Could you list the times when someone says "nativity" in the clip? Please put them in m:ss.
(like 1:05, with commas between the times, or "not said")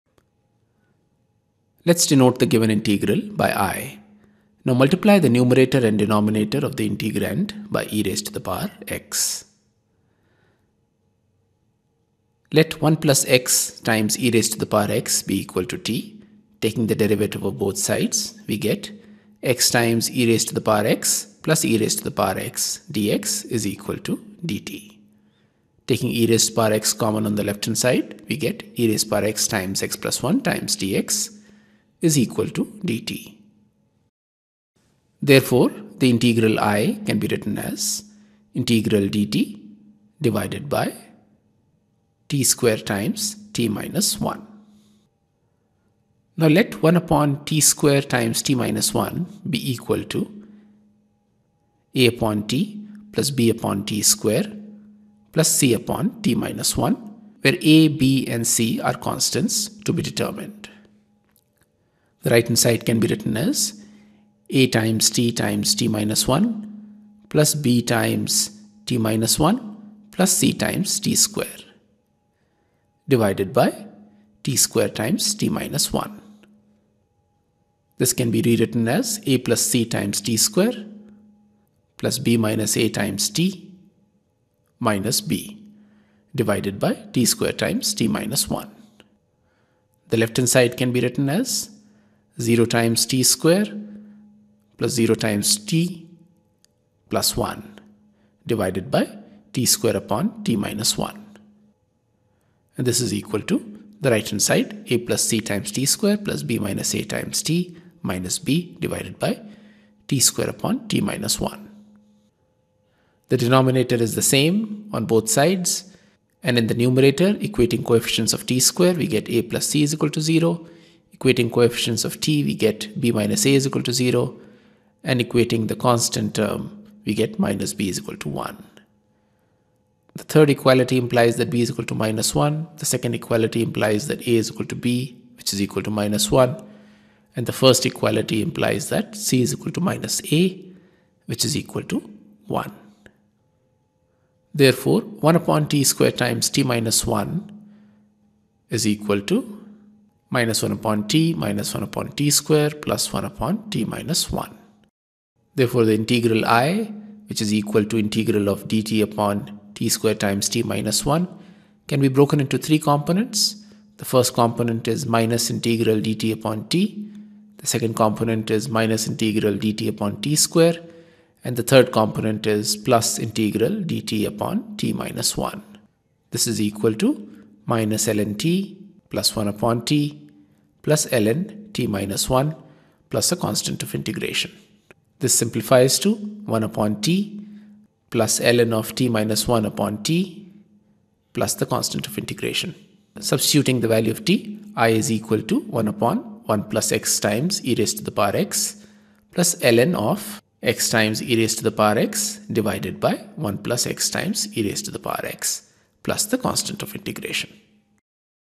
not said.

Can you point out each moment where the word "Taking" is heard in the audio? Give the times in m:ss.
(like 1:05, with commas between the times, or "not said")
0:16, 0:25.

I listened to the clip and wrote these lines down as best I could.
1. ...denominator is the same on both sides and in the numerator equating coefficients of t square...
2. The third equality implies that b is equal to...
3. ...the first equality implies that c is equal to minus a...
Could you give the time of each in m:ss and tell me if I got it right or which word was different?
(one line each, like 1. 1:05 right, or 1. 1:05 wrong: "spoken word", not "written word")
1. 1:53 right
2. 2:10 right
3. 2:17 right.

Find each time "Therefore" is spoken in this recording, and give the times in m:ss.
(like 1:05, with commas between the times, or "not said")
0:35, 2:24, 2:35.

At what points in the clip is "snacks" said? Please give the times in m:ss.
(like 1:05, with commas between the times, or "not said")
not said.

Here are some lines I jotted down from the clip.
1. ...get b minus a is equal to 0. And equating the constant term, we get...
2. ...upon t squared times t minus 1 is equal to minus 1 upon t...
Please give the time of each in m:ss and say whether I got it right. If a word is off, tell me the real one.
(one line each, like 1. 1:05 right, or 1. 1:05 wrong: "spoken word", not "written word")
1. 2:02 right
2. 2:25 right.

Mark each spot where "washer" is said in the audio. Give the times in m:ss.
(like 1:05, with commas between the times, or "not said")
not said.